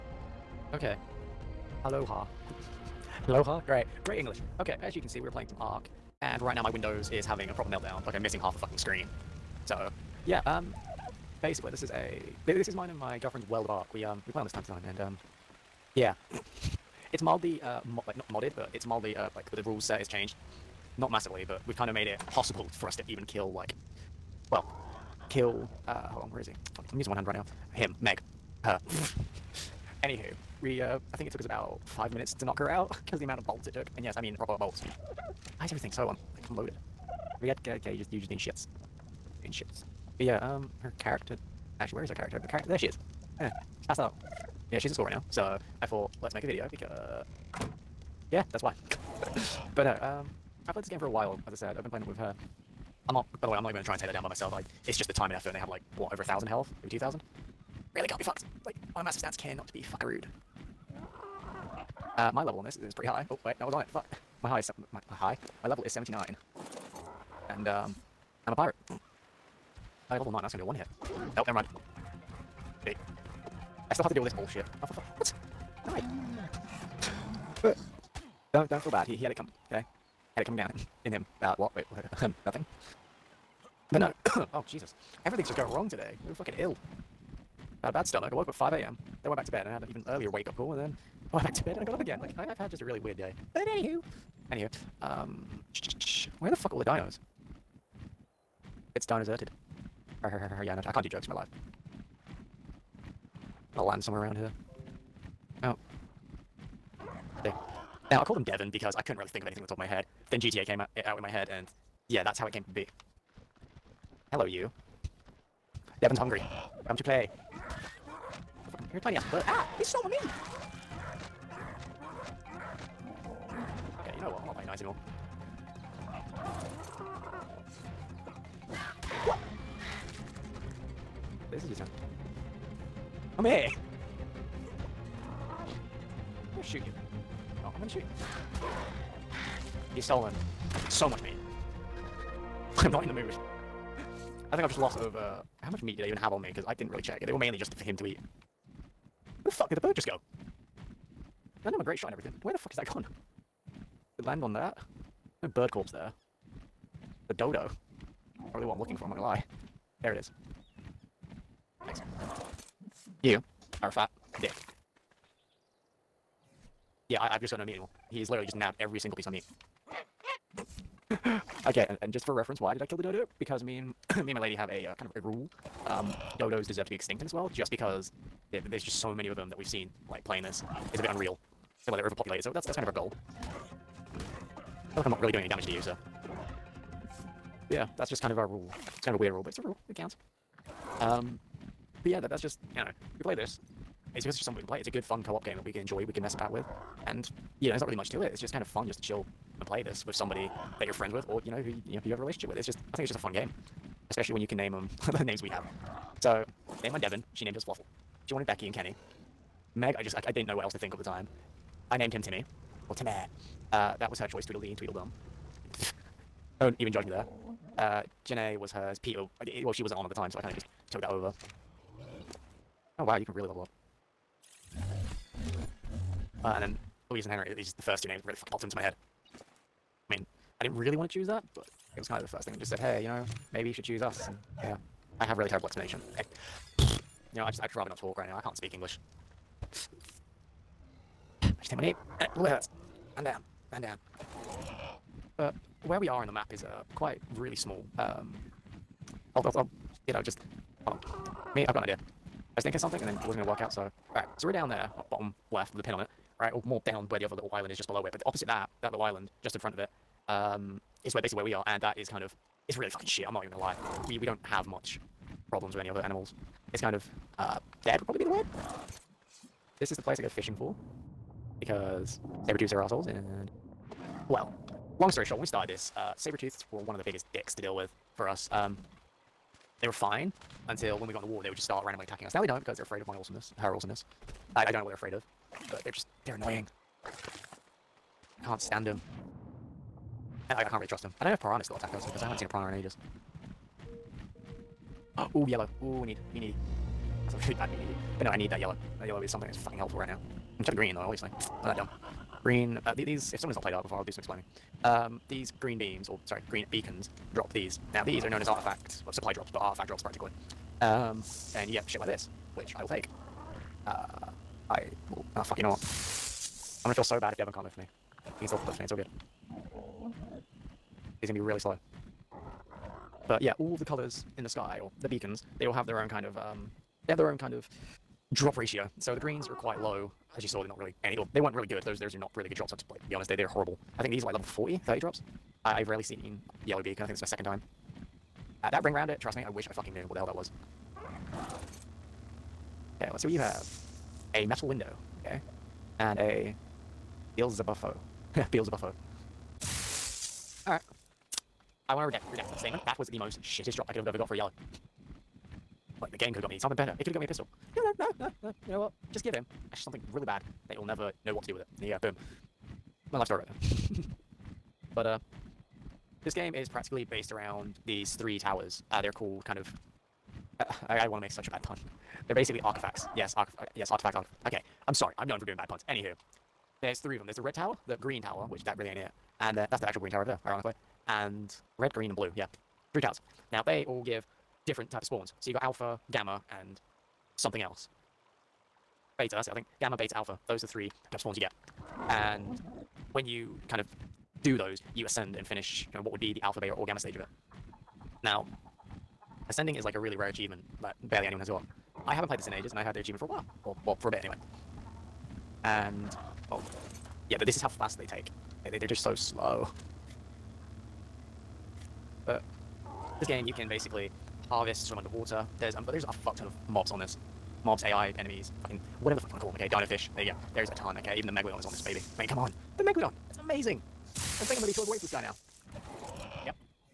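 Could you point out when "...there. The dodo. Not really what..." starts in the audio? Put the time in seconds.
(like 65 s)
155 s.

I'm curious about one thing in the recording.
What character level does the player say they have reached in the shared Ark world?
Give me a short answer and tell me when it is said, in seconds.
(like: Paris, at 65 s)
79, at 65 s.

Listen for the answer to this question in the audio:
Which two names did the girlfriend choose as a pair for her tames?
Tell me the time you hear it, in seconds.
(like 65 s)
214 s.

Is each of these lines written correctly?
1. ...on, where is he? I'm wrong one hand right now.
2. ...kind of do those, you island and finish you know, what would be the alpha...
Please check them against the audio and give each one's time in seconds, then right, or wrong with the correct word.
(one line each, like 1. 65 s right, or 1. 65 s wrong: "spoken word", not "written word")
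1. 26 s wrong: "using", not "wrong"
2. 393 s wrong: "ascend", not "island".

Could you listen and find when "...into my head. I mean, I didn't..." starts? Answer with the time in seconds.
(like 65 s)
228 s.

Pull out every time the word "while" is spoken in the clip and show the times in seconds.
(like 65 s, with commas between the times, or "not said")
51 s, 403 s.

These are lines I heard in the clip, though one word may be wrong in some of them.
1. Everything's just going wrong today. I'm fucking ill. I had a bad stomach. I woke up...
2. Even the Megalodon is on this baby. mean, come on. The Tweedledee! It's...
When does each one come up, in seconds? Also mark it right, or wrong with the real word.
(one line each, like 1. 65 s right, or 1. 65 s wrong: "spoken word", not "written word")
1. 85 s right
2. 421 s wrong: "Megalodon", not "Tweedledee".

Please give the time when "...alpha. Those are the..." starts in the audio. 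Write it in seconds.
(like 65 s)
390 s.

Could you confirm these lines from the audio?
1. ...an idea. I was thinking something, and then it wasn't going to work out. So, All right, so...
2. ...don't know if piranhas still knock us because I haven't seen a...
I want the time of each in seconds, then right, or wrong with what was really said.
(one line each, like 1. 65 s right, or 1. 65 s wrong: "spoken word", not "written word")
1. 251 s right
2. 291 s wrong: "attack", not "knock".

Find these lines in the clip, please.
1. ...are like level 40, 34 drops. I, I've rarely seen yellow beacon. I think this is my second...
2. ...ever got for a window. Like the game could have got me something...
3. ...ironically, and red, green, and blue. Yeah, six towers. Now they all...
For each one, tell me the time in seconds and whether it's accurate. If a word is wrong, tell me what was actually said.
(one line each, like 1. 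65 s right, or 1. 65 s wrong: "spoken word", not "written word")
1. 334 s wrong: "30", not "34"
2. 354 s wrong: "yellow", not "window"
3. 380 s wrong: "three", not "six".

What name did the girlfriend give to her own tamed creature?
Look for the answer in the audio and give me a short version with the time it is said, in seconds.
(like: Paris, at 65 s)
Fluffle, at 207 s.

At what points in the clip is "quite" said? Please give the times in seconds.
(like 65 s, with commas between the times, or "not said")
246 s, 329 s.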